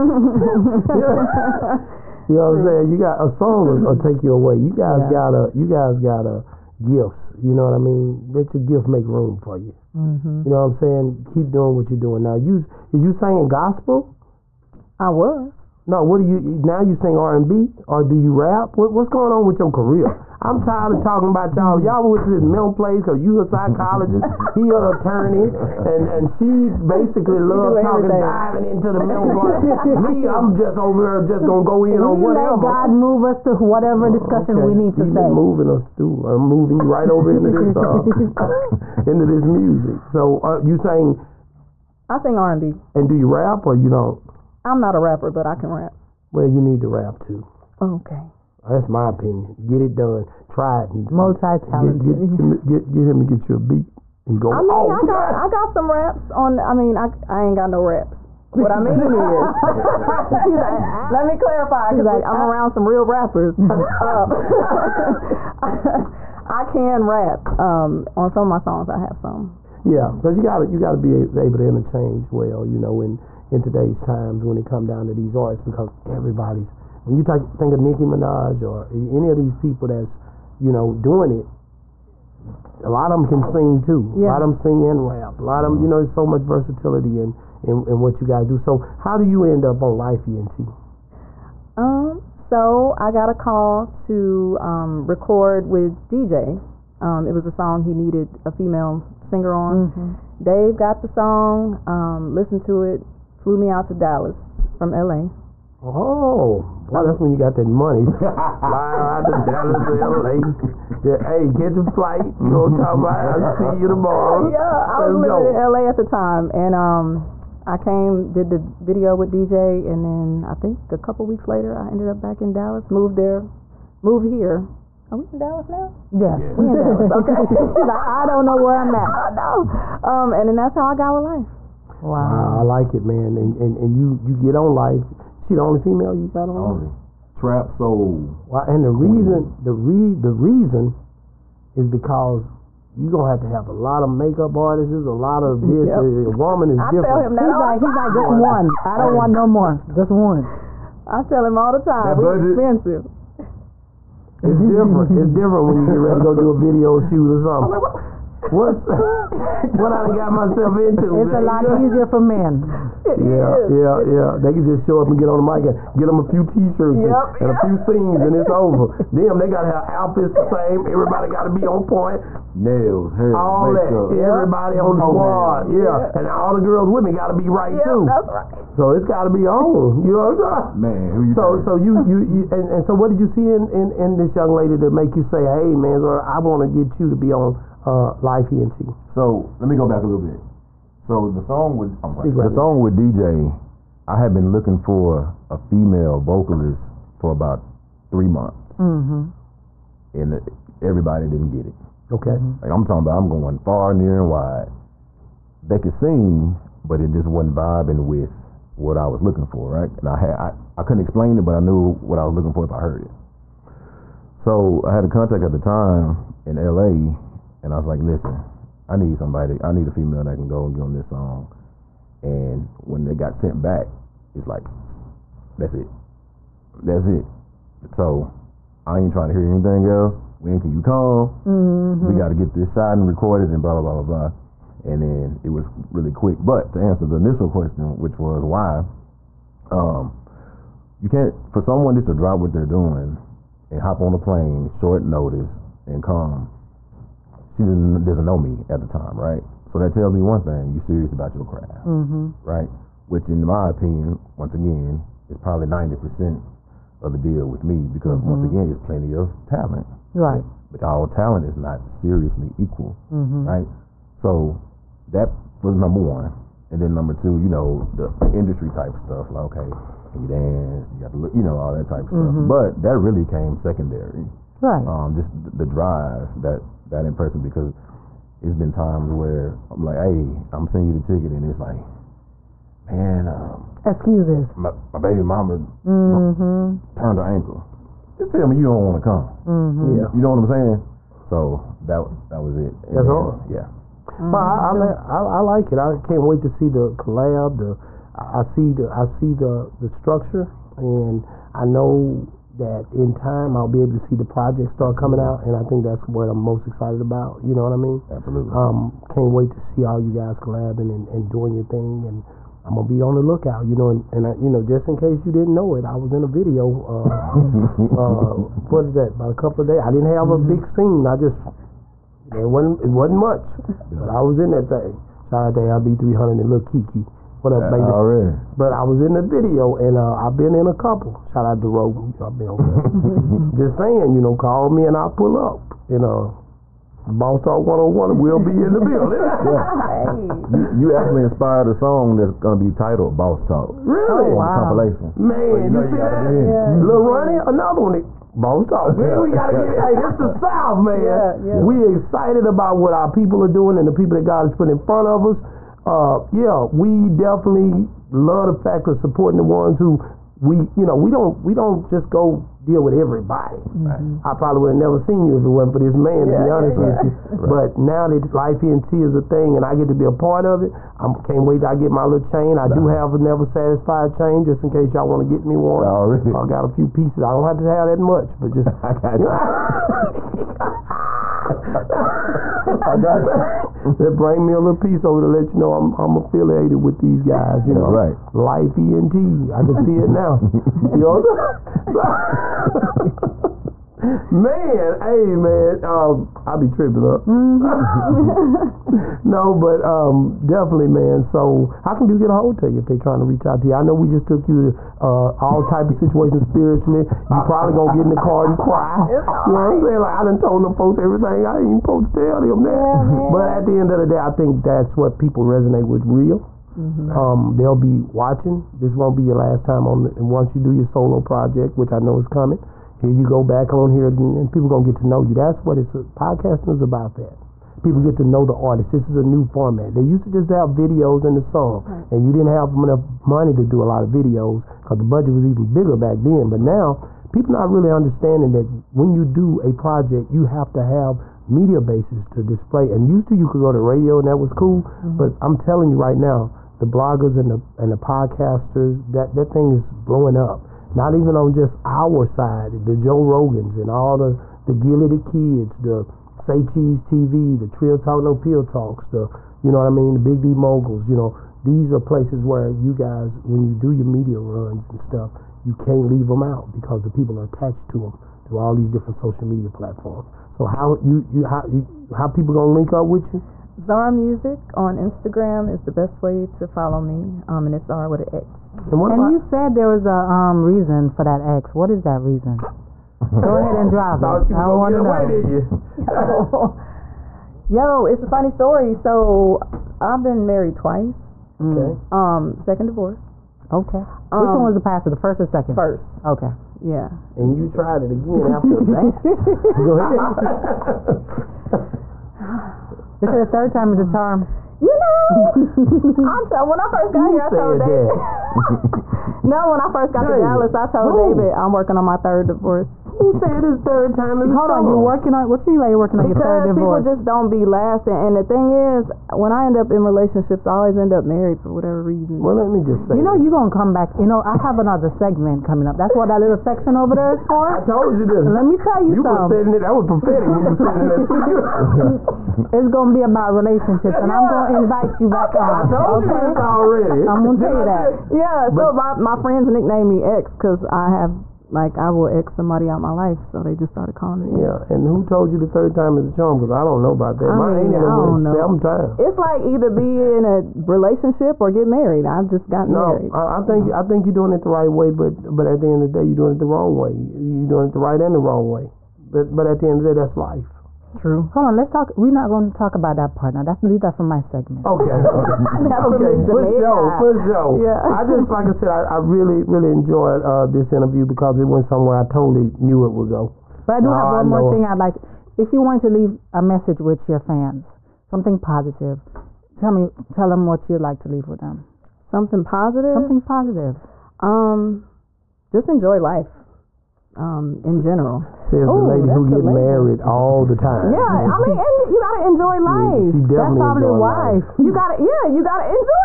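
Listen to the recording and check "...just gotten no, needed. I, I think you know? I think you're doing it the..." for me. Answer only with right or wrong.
wrong.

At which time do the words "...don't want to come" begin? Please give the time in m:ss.
4:48.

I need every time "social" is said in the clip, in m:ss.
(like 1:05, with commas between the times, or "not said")
7:49.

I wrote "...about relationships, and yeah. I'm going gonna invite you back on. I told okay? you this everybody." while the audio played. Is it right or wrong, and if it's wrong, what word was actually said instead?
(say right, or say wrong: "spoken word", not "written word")
wrong: "already", not "everybody".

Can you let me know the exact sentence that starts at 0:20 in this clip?
I'm tired of talking about y'all.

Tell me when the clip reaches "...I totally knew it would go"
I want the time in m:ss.
9:32.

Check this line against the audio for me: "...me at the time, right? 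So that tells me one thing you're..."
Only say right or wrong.
right.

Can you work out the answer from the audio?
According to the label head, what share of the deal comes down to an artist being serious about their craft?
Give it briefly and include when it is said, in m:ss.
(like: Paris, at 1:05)
90%, at 4:15.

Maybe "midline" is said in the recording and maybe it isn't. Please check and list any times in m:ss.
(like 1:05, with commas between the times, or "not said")
not said.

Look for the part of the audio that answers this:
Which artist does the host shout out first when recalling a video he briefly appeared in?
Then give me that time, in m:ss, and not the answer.
5:25.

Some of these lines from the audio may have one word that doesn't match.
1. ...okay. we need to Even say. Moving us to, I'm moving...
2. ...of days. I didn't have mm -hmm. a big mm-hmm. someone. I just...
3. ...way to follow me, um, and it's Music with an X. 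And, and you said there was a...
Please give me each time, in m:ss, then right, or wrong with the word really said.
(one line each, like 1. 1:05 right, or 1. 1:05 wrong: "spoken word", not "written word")
1. 0:34 right
2. 5:19 wrong: "scene", not "someone"
3. 7:56 wrong: "Xara", not "Music".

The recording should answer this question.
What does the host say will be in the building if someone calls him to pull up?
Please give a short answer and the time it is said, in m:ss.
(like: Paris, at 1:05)
Boss Talk 101, at 5:37.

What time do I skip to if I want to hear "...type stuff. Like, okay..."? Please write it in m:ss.
4:28.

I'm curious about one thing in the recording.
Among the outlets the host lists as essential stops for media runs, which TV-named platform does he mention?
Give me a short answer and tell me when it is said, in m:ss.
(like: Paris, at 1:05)
Say Cheese TV, at 7:36.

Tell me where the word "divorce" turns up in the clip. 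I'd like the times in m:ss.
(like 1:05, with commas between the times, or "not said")
8:12, 8:32, 8:36.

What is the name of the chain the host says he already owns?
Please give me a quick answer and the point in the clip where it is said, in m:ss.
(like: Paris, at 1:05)
Never Satisfied, at 6:13.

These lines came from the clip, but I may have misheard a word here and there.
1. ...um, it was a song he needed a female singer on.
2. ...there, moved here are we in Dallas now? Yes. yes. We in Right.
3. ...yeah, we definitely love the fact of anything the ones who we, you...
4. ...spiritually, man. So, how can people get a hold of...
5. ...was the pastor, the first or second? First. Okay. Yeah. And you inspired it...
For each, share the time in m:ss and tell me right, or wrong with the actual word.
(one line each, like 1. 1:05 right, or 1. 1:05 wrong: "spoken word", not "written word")
1. 1:37 right
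2. 2:03 wrong: "Dallas", not "Right"
3. 5:56 wrong: "supporting", not "anything"
4. 6:40 wrong: "definitely", not "spiritually"
5. 8:14 wrong: "tried", not "inspired".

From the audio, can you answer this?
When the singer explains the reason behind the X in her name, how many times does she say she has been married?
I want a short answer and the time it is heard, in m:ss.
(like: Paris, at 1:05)
twice, at 8:10.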